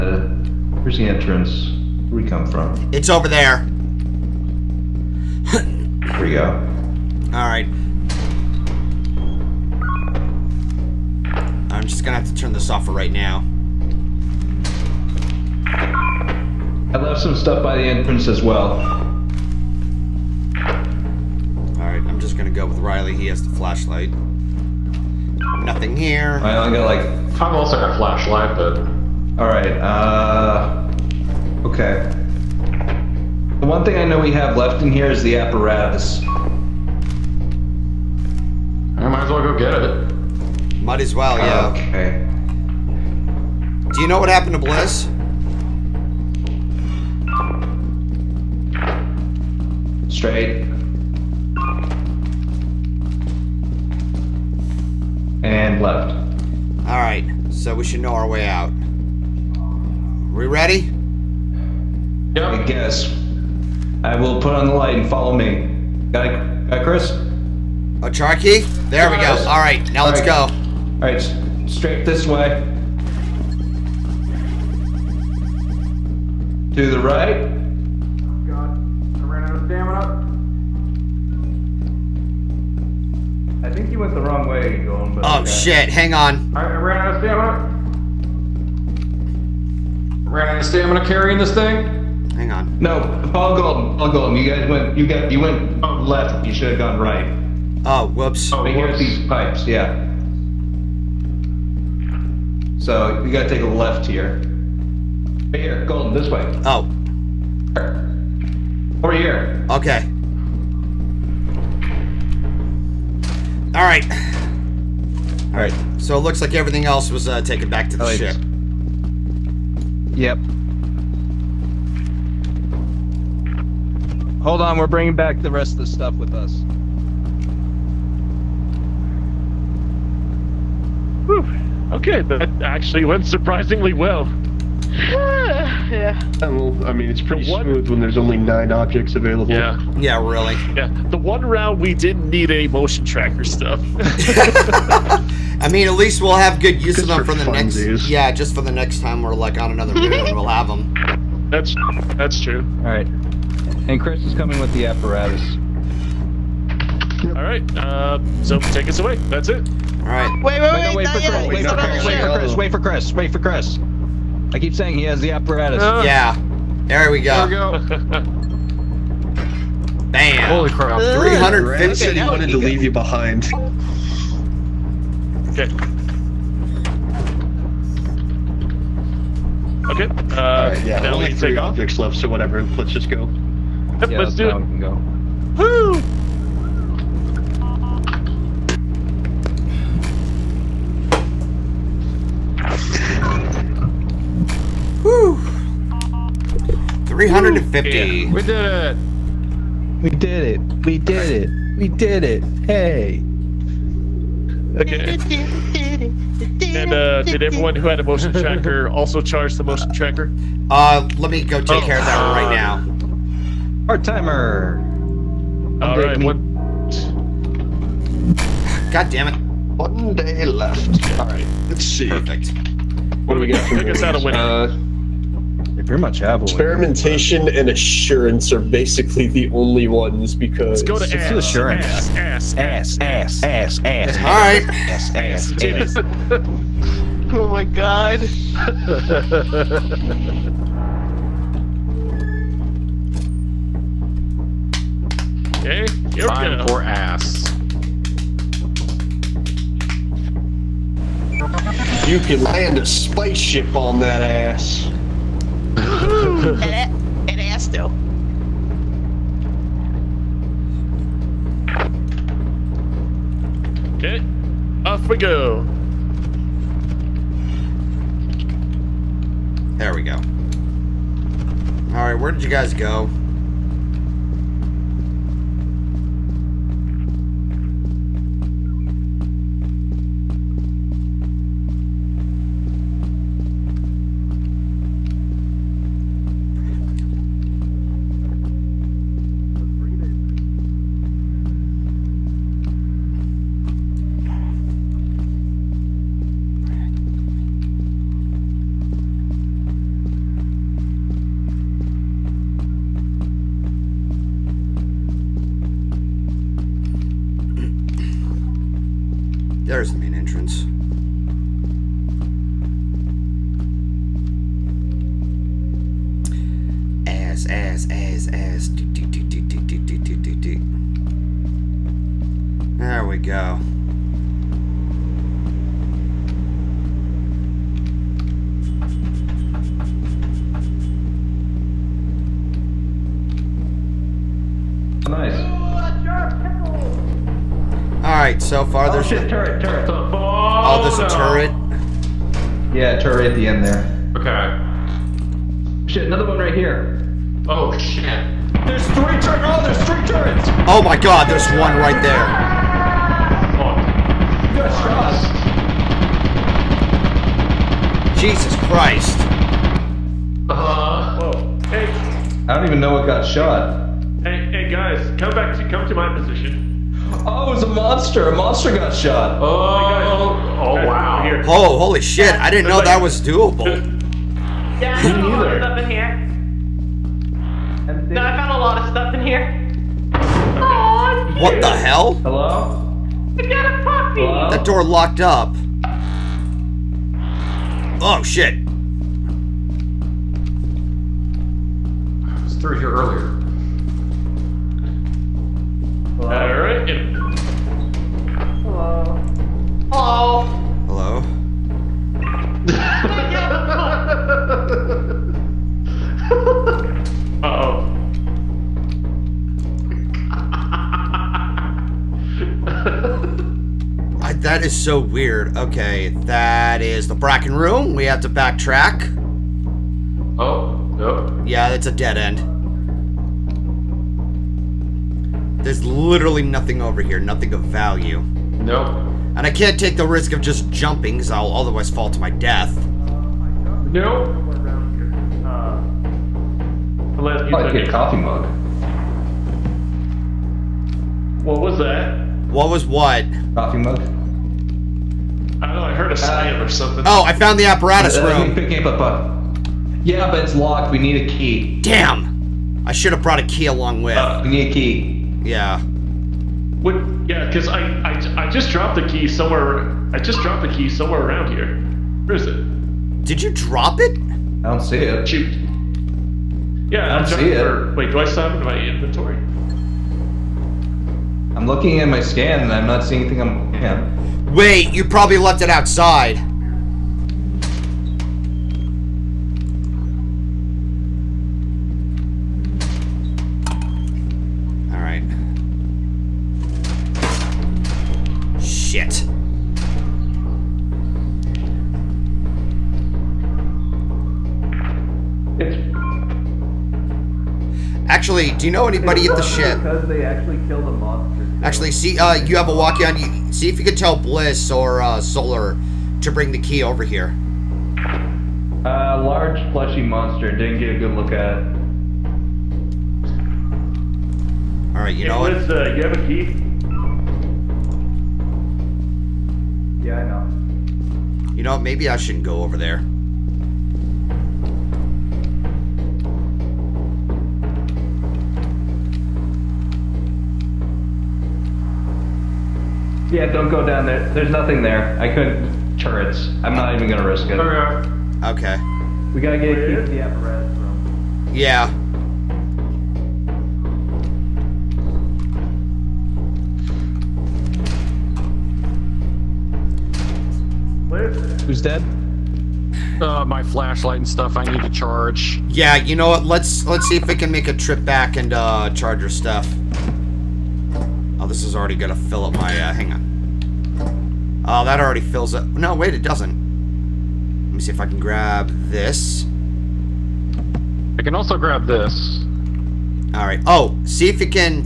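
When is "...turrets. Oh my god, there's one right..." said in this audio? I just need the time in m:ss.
5:50.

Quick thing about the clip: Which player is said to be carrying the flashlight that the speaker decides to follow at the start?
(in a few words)
Riley.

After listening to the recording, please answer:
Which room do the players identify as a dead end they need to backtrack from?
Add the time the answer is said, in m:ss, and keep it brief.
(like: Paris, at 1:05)
The Bracken room, at 6:57.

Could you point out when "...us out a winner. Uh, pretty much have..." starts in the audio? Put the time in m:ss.
3:43.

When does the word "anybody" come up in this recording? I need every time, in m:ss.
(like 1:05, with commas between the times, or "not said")
8:18.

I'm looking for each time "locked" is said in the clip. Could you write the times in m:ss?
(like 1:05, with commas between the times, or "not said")
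6:24, 7:30.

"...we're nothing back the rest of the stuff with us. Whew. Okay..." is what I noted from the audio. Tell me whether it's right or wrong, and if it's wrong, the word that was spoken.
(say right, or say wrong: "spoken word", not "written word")
wrong: "bringing", not "nothing".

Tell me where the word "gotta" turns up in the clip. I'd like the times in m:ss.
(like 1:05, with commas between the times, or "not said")
1:43, 8:59.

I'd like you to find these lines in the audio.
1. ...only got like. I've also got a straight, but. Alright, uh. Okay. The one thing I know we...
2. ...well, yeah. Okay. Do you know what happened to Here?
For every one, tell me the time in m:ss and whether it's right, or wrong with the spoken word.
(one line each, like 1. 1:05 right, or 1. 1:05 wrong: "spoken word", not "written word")
1. 0:26 wrong: "flashlight", not "straight"
2. 0:41 wrong: "Bliss", not "Here".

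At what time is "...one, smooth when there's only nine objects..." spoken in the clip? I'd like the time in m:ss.
2:17.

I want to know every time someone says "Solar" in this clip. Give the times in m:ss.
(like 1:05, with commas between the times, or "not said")
8:25.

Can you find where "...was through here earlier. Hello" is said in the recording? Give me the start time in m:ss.
6:32.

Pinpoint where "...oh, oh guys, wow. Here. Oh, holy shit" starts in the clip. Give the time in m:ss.
6:09.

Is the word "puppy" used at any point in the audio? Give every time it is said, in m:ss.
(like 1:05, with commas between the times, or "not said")
6:24.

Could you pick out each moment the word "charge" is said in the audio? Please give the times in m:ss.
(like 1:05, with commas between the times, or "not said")
3:29, 9:14, 9:18.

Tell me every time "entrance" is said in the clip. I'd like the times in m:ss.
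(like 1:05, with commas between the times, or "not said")
0:01, 0:17, 5:10.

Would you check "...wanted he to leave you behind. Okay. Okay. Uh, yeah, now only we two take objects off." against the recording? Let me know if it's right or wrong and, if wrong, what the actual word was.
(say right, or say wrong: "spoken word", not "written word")
wrong: "three", not "two".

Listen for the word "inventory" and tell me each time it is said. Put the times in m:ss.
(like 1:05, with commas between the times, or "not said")
7:48.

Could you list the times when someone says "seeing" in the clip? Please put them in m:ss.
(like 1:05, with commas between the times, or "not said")
7:53.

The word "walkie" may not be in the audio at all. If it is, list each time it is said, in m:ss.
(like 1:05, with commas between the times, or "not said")
8:22.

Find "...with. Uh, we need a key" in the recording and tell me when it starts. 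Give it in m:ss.
7:34.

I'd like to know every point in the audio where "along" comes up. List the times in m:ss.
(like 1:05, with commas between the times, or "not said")
7:33.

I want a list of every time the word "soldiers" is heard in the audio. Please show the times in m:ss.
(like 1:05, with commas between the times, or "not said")
not said.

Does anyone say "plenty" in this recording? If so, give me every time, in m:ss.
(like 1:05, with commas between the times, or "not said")
not said.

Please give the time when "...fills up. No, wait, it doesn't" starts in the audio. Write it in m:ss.
9:25.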